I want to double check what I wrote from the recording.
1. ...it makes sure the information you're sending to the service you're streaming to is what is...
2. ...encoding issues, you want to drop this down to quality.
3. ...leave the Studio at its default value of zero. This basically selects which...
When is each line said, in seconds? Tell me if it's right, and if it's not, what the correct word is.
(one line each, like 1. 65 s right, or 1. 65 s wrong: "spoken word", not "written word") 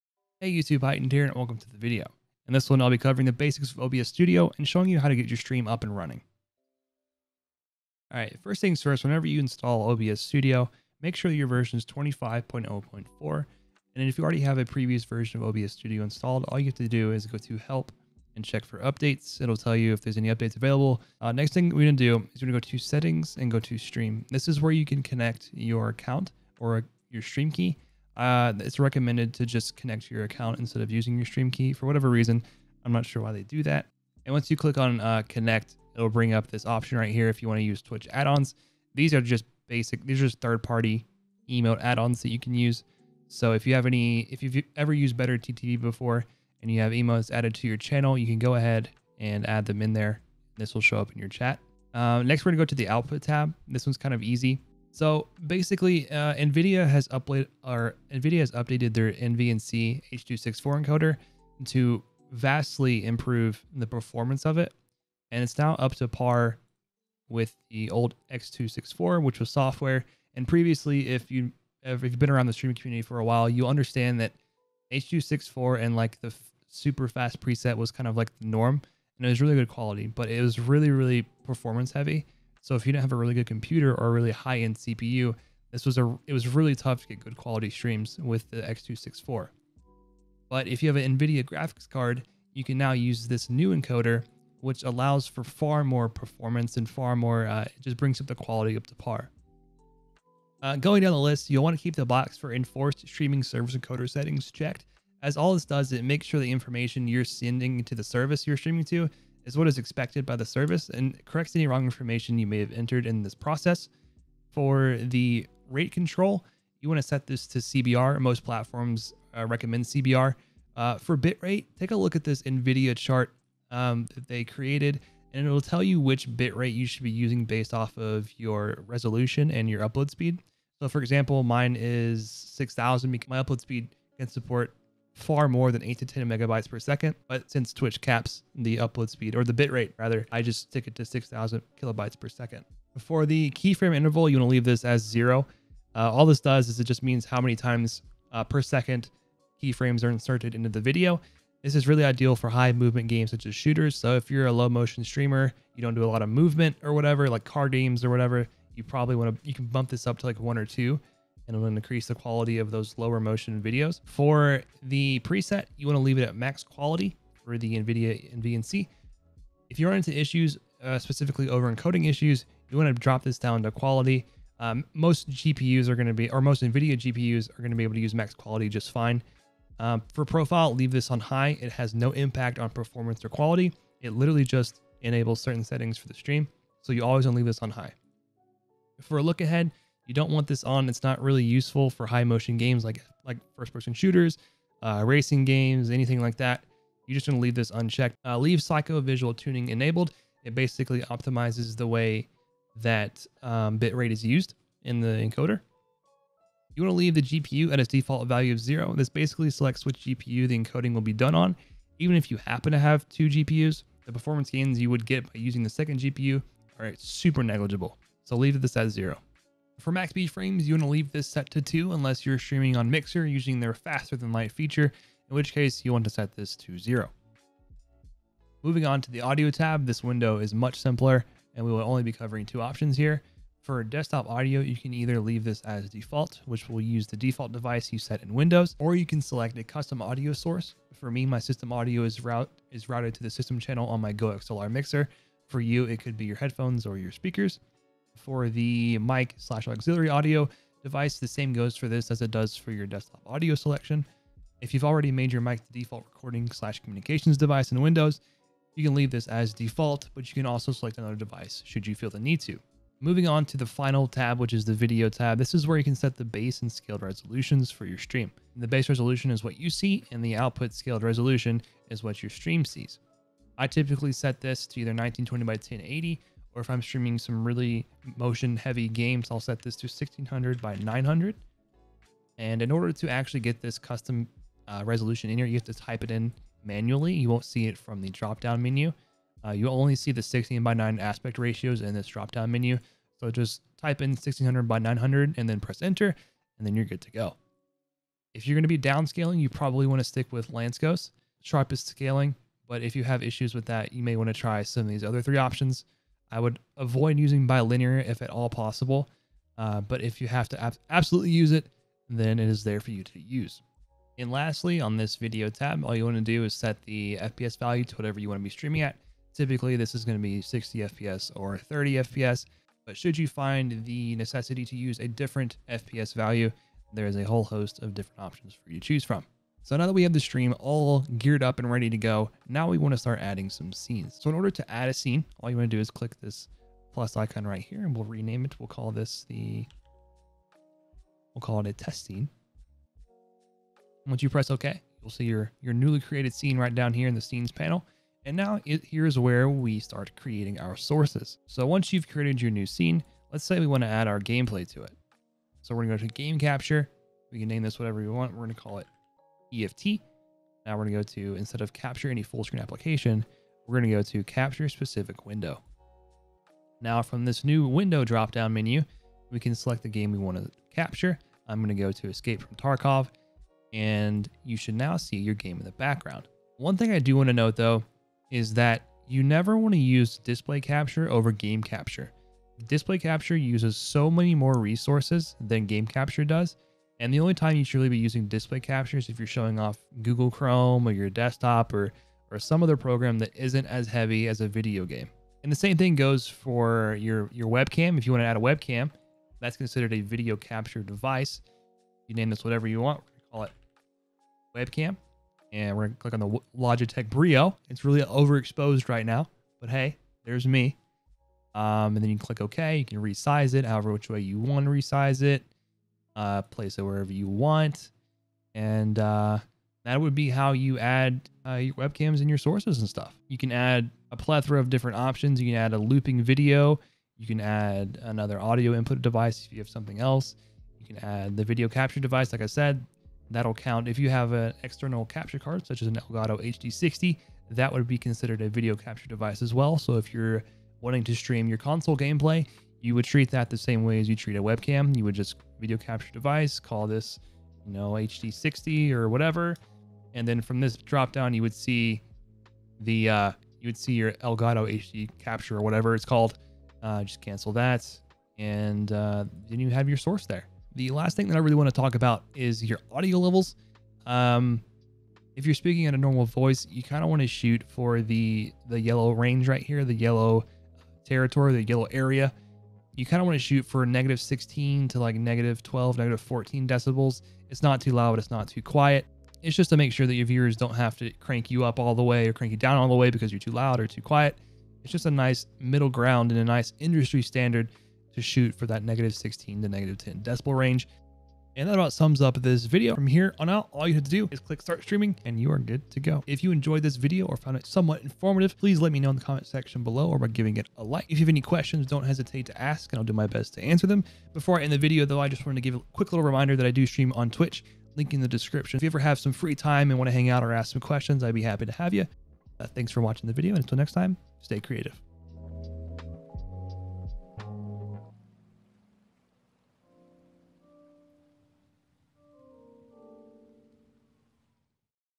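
1. 105 s right
2. 171 s right
3. 206 s wrong: "GPU", not "Studio".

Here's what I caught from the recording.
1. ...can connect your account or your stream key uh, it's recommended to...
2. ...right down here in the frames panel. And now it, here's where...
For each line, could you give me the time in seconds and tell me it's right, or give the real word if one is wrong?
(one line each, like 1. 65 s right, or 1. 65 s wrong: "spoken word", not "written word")
1. 24 s right
2. 346 s wrong: "scenes", not "frames".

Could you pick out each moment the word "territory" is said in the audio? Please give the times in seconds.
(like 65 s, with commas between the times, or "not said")
471 s.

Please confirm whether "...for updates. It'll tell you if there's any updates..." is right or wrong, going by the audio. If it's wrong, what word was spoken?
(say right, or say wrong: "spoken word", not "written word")
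right.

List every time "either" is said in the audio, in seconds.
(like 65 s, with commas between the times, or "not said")
234 s, 274 s.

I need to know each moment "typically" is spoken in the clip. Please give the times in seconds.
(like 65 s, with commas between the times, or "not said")
273 s, 319 s.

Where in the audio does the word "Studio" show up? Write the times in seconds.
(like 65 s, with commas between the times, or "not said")
4 s, 10 s, 15 s.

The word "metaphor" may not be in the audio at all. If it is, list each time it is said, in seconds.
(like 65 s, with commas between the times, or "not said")
not said.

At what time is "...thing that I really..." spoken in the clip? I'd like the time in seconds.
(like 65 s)
461 s.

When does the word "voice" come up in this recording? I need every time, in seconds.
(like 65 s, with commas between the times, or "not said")
466 s.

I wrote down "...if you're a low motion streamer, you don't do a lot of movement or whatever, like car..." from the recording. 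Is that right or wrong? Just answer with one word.
right.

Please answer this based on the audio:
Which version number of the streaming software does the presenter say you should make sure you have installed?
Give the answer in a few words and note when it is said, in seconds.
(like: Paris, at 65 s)
25.0.4, at 11 s.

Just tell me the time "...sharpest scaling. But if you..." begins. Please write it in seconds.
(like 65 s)
301 s.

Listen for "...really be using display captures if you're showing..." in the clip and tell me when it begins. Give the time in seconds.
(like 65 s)
387 s.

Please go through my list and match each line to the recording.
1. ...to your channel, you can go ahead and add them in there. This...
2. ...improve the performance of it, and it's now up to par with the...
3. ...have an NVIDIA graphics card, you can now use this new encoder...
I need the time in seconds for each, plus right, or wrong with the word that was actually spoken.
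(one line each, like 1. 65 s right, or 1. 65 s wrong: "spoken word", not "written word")
1. 47 s right
2. 63 s right
3. 90 s right.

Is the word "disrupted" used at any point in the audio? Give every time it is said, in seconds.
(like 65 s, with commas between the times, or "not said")
not said.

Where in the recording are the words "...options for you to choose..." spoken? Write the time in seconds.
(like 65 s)
328 s.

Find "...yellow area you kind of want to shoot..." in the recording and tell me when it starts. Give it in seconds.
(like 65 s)
471 s.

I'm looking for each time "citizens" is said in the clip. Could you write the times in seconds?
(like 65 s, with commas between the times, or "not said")
not said.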